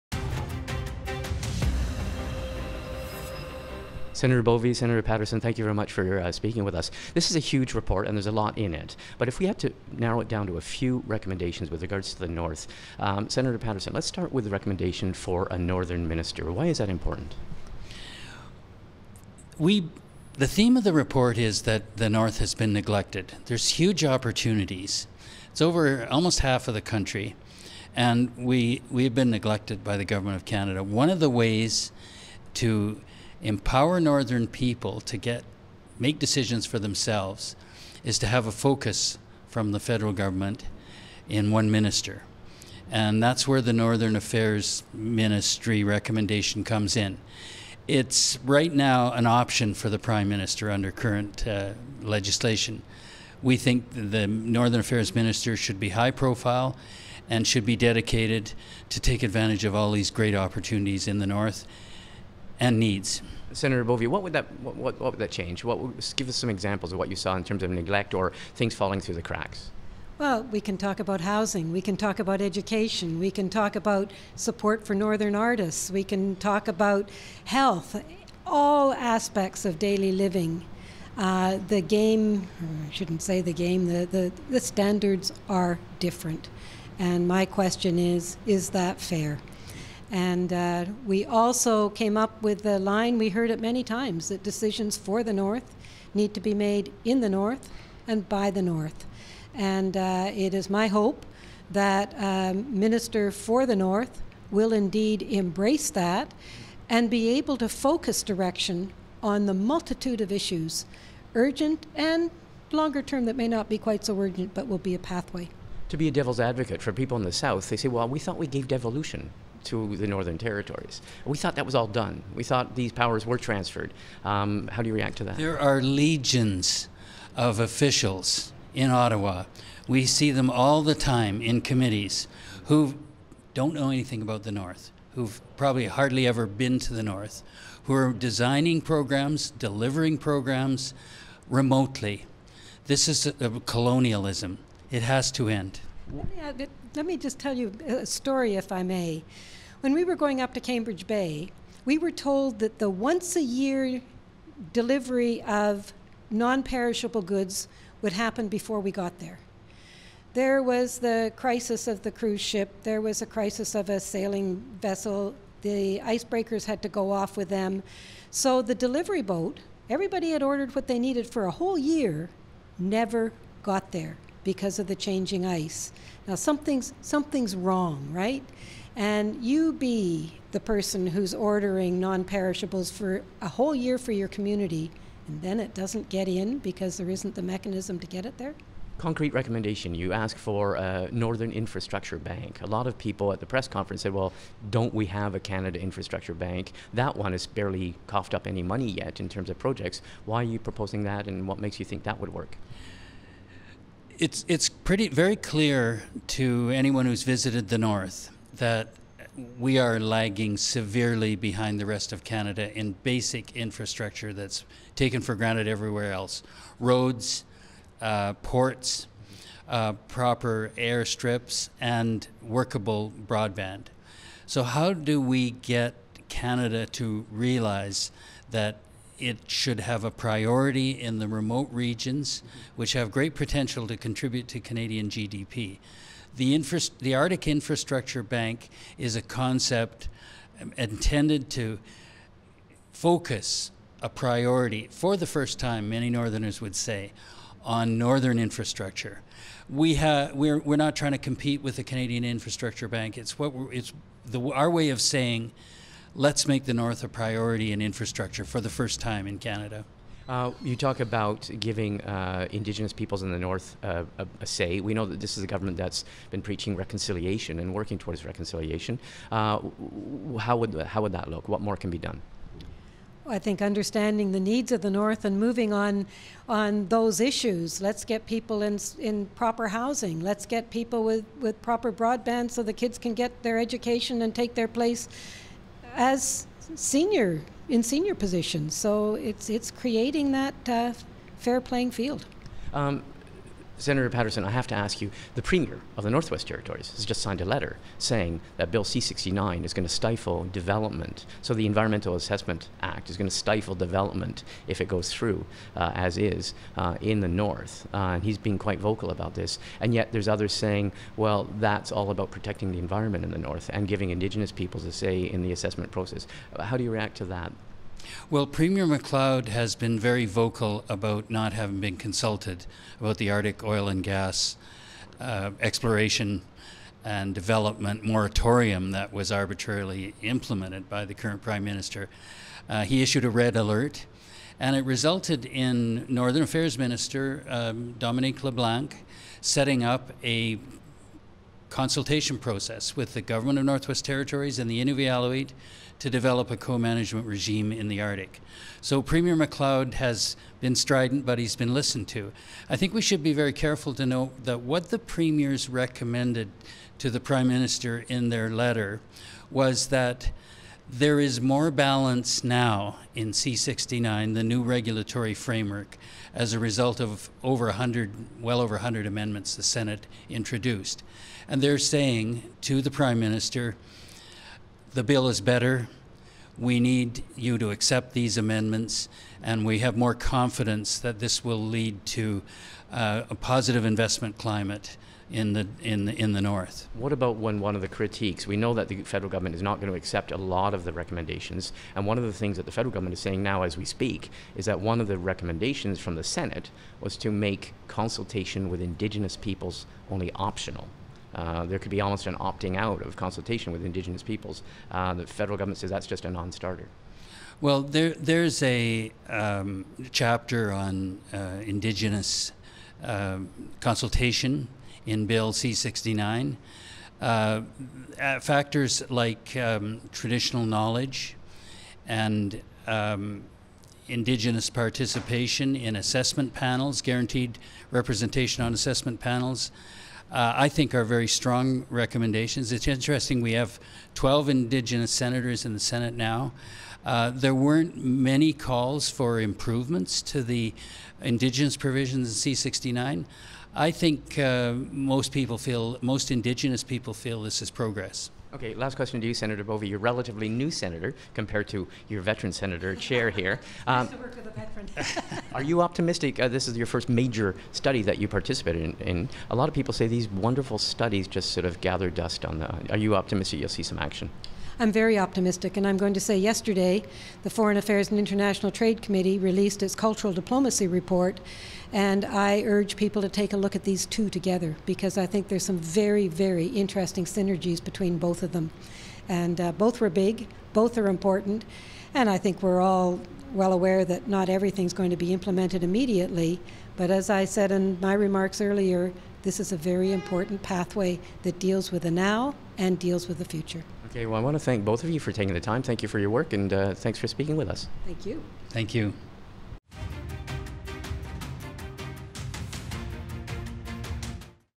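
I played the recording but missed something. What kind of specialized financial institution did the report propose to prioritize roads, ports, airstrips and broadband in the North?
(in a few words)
Arctic Infrastructure Bank.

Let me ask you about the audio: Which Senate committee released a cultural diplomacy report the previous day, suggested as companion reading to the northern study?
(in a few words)
Foreign Affairs and International Trade Committee.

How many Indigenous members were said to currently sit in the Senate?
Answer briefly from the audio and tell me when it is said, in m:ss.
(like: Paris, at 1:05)
12, at 7:14.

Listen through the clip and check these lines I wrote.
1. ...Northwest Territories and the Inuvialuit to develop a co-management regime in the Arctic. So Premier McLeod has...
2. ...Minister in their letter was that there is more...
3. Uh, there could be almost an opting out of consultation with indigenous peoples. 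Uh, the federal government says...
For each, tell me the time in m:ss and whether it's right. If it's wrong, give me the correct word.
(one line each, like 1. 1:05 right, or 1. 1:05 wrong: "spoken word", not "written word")
1. 5:43 right
2. 5:57 right
3. 6:41 right.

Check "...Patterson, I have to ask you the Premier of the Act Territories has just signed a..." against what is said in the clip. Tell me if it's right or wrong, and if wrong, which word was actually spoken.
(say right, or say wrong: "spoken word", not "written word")
wrong: "Northwest", not "Act".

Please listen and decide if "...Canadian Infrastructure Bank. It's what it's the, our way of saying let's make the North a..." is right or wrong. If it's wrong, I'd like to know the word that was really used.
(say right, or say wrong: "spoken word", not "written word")
right.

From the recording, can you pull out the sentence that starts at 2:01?
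We thought that was all done.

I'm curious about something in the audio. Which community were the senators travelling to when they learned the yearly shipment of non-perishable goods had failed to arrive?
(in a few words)
Cambridge Bay.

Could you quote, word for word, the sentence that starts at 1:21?
Uh, the game, I shouldn't say the game, the, the, the standards are different.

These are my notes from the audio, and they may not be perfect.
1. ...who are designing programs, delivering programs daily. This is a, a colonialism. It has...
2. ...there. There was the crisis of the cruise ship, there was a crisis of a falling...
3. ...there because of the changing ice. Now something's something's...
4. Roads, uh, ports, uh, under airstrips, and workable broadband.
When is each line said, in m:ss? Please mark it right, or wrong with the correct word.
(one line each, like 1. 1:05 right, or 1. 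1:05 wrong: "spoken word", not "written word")
1. 2:17 wrong: "remotely", not "daily"
2. 2:39 wrong: "sailing", not "falling"
3. 2:53 right
4. 3:36 wrong: "proper", not "under".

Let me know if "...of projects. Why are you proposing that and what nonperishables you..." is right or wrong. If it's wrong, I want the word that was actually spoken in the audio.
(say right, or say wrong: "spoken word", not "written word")
wrong: "makes", not "nonperishables".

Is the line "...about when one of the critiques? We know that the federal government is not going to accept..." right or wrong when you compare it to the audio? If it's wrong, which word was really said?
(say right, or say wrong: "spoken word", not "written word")
right.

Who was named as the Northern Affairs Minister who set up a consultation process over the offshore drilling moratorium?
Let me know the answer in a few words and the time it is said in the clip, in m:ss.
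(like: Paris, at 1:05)
Dominic LeBlanc, at 5:37.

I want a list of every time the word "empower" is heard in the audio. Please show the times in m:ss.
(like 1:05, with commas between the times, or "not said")
0:33.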